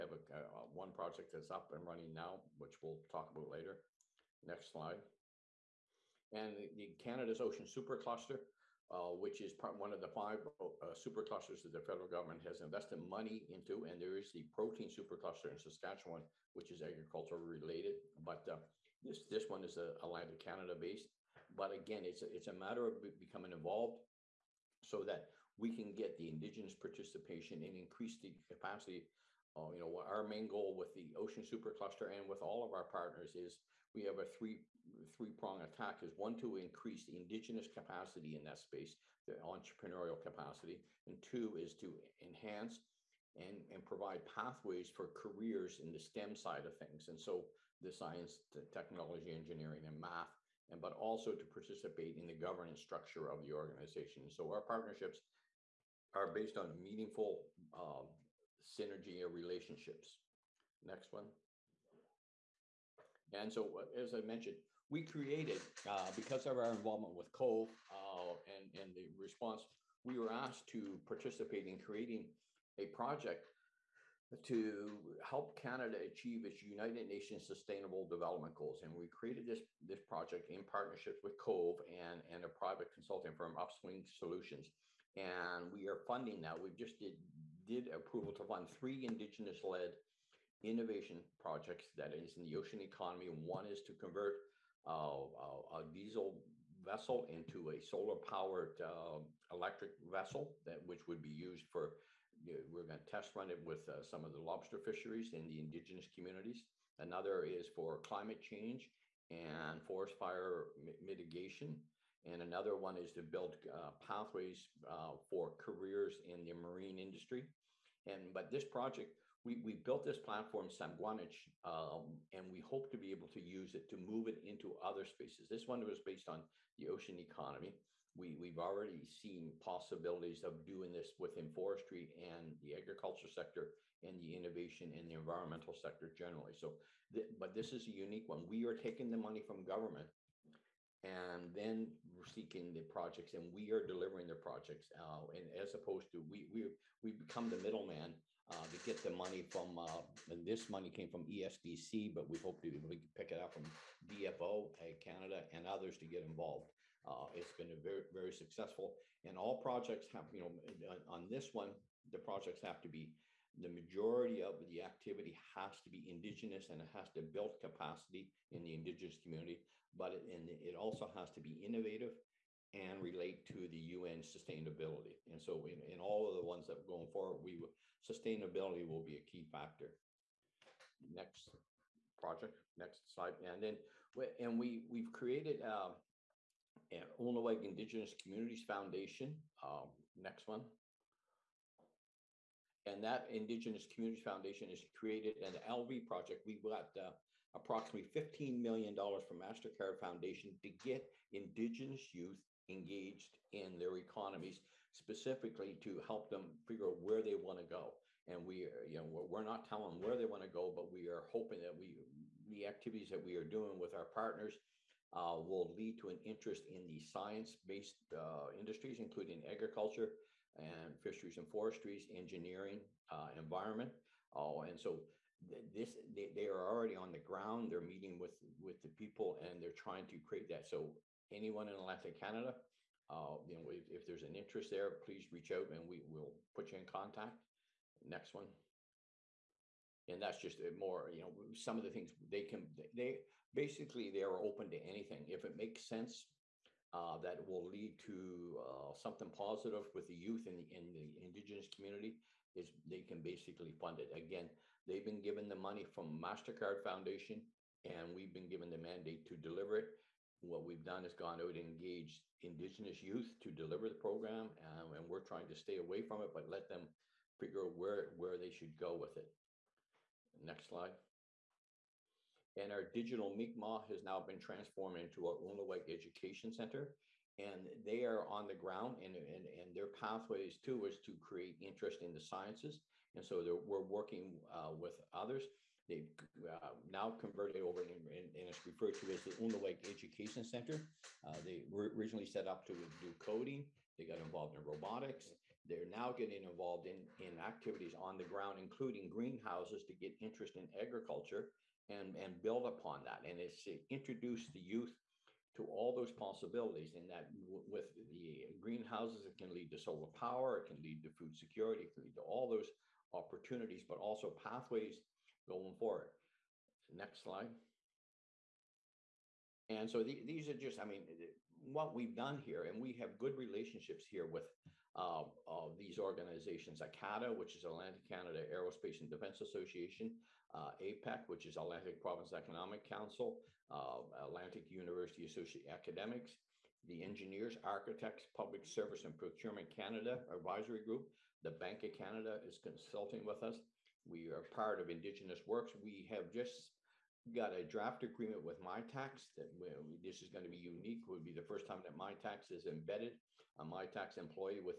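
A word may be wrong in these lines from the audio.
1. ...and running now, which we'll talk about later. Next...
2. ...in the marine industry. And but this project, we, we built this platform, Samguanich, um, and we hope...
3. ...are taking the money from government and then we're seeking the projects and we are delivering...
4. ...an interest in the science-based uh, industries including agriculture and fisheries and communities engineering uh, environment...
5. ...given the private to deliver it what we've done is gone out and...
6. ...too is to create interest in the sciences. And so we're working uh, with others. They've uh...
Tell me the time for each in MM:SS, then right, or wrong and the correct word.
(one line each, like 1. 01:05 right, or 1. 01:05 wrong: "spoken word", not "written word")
1. 00:01 right
2. 01:56 right
3. 02:18 right
4. 03:36 wrong: "forestries", not "communities"
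5. 04:18 wrong: "mandate", not "private"
6. 04:40 right.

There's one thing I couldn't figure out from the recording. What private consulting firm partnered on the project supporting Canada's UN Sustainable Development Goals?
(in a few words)
Upswing Solutions.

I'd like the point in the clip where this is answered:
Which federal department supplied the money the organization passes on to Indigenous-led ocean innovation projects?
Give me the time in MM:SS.
02:31.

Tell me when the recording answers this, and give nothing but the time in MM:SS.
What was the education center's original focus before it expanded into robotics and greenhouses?
04:53.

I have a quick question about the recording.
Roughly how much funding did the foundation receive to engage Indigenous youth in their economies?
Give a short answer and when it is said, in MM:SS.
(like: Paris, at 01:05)
$15 million, at 03:18.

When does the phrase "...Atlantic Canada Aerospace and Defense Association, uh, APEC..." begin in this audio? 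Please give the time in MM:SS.
05:27.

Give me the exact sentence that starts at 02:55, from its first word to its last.
And so in, in all of the ones that are going forward, we sustainability will be a key factor.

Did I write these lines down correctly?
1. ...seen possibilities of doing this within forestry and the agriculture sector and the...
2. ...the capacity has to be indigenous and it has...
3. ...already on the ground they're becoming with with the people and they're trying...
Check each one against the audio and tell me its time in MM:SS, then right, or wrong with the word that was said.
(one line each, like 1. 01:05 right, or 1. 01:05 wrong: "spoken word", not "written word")
1. 02:09 right
2. 02:44 wrong: "activity", not "capacity"
3. 03:46 wrong: "meeting", not "becoming".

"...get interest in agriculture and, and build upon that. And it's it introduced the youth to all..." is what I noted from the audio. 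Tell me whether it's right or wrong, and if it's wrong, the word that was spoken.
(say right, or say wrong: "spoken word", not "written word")
right.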